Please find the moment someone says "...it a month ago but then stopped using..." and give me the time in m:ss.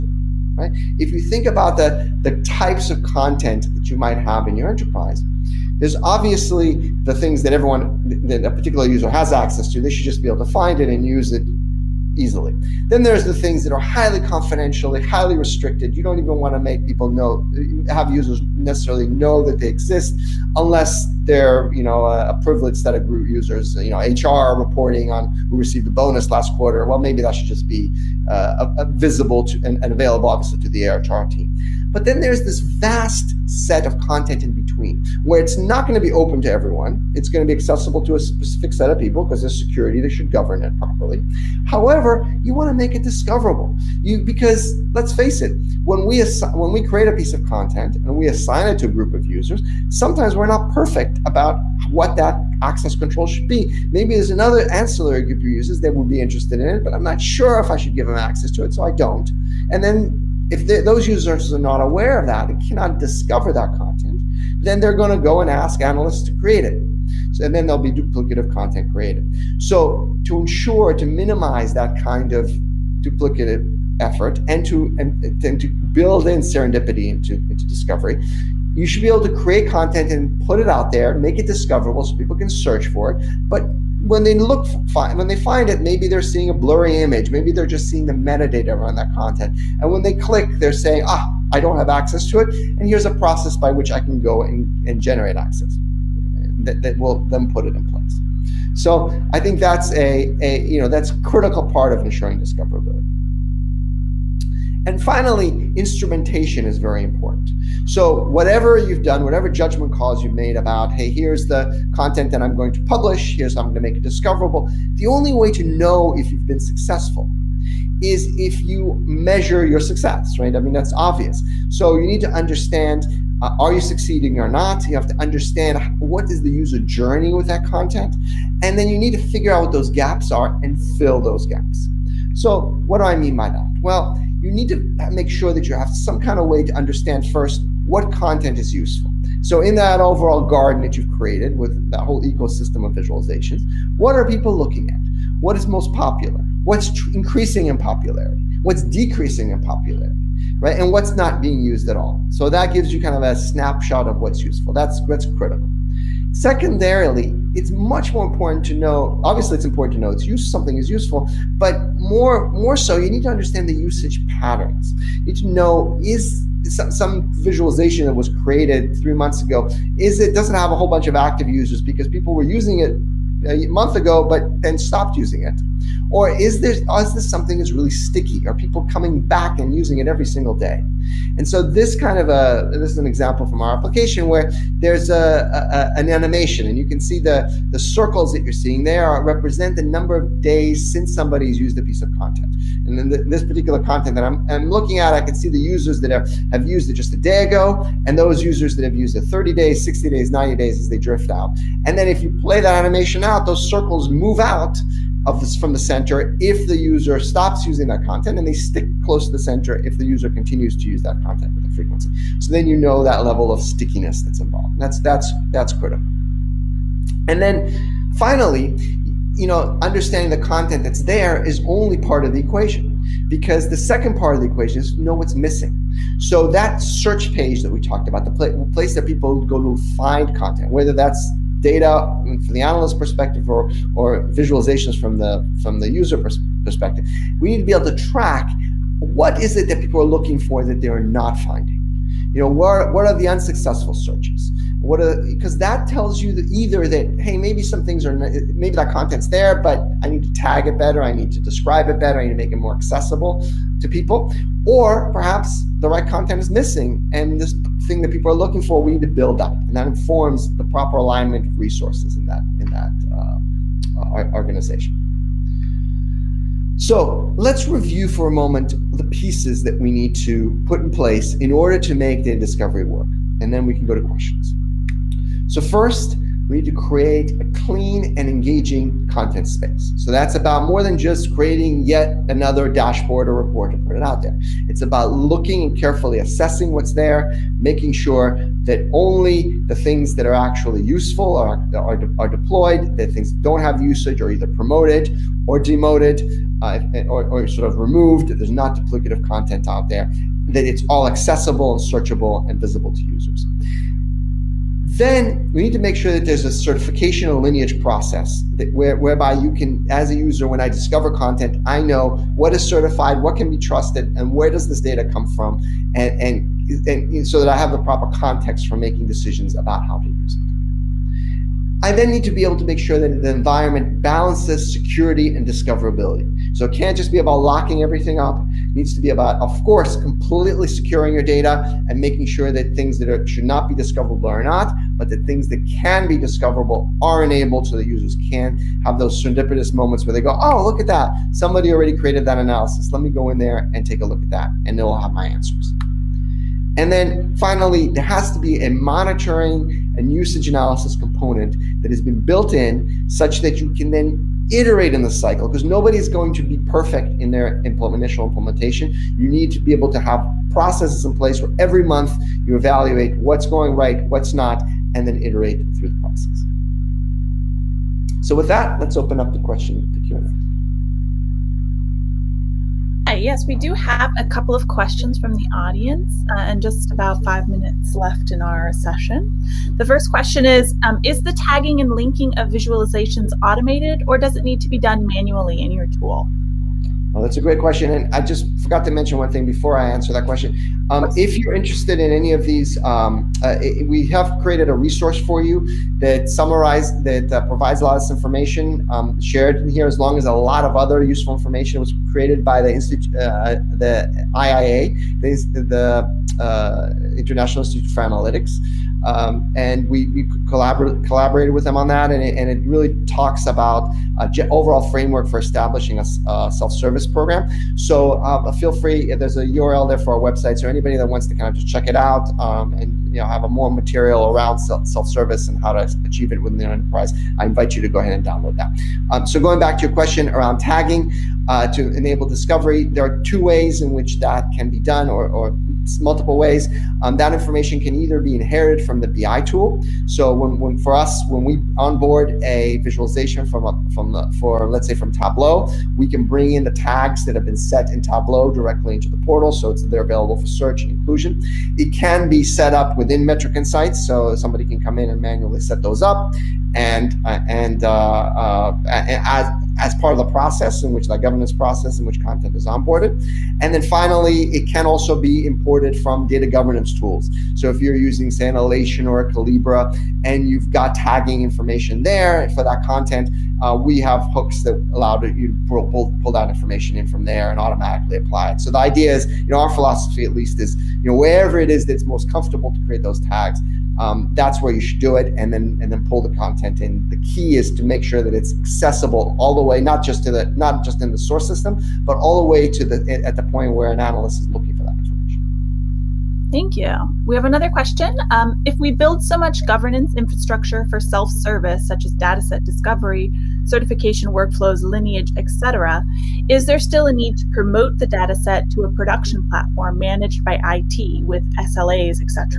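2:52.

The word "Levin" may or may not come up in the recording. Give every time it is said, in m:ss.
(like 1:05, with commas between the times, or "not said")
not said.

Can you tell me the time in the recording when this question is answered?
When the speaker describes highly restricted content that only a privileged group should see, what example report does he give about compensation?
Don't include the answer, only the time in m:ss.
0:25.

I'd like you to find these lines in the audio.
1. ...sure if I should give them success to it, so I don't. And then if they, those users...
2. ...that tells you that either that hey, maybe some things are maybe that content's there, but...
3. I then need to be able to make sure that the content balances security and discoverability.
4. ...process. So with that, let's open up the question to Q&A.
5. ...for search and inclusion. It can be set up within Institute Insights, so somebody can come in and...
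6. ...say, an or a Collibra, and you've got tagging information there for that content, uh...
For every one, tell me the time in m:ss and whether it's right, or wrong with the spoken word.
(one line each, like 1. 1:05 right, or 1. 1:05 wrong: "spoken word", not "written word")
1. 0:57 wrong: "access", not "success"
2. 4:05 right
3. 5:21 wrong: "environment", not "content"
4. 6:05 right
5. 7:30 wrong: "Metric", not "Institute"
6. 7:48 right.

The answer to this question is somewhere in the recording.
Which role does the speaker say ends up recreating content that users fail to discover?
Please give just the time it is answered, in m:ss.
1:05.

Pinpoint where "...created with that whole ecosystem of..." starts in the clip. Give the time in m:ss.
2:21.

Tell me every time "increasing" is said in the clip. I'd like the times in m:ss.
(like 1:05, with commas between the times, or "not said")
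2:27.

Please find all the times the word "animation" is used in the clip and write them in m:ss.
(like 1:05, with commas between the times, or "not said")
3:06, 3:22.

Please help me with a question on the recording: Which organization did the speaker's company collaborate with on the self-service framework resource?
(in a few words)
International Institute for Analytics.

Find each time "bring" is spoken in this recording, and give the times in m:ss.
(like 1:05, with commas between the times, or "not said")
7:26.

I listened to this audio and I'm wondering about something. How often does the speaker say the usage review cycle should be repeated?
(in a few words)
every month.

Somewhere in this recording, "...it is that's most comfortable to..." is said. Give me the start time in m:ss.
8:01.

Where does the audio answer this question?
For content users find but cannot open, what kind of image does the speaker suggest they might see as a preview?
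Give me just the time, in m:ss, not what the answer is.
1:26.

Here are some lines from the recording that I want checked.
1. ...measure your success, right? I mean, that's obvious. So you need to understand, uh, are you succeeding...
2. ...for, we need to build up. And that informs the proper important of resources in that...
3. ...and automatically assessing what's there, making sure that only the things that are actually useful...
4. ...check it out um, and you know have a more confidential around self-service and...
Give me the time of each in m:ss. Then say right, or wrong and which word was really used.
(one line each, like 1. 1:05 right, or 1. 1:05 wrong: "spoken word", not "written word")
1. 1:59 right
2. 4:18 wrong: "alignment", not "important"
3. 4:45 wrong: "carefully", not "automatically"
4. 7:01 wrong: "material", not "confidential".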